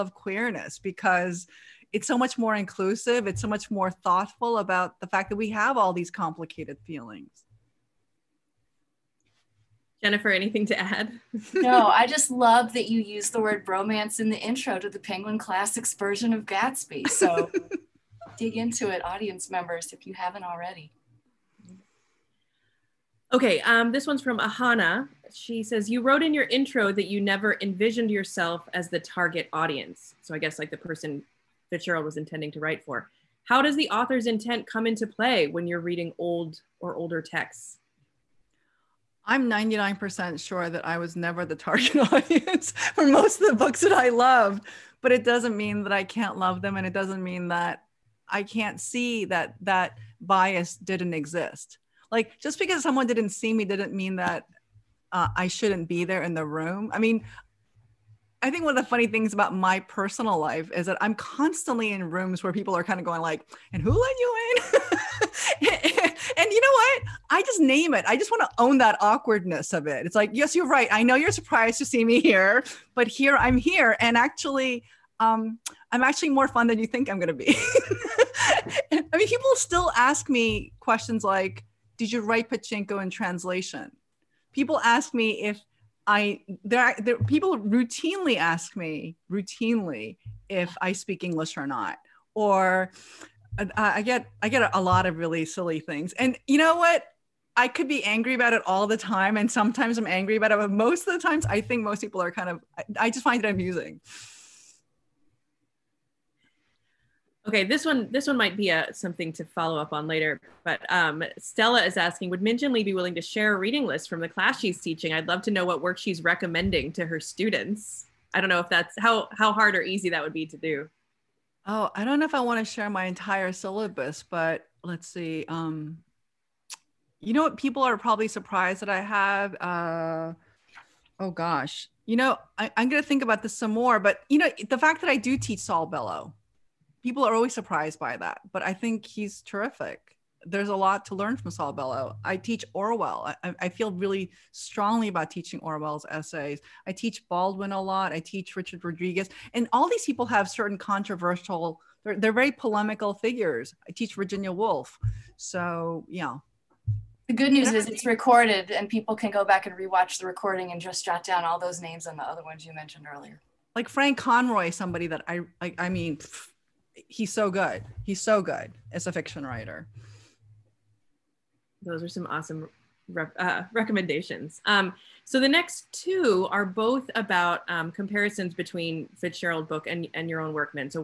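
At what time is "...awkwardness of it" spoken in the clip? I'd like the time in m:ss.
1:09.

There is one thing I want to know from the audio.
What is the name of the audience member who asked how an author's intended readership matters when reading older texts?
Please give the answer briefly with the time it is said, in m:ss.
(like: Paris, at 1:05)
Ahana, at 0:24.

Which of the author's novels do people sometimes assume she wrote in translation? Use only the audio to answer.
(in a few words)
Pachinko.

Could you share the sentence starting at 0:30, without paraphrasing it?
So I guess like the person Fitzgerald was intending to write for.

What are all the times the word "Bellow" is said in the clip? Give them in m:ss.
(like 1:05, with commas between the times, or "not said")
2:15, 2:21.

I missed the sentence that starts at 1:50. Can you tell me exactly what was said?
But um, Stella is asking, would Min Jin Lee be willing to share a reading list from the class she's teaching?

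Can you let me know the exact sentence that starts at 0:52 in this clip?
Like just because someone didn't see me didn't mean that uh, I shouldn't be there in the room.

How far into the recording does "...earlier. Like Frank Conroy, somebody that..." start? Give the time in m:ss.
2:43.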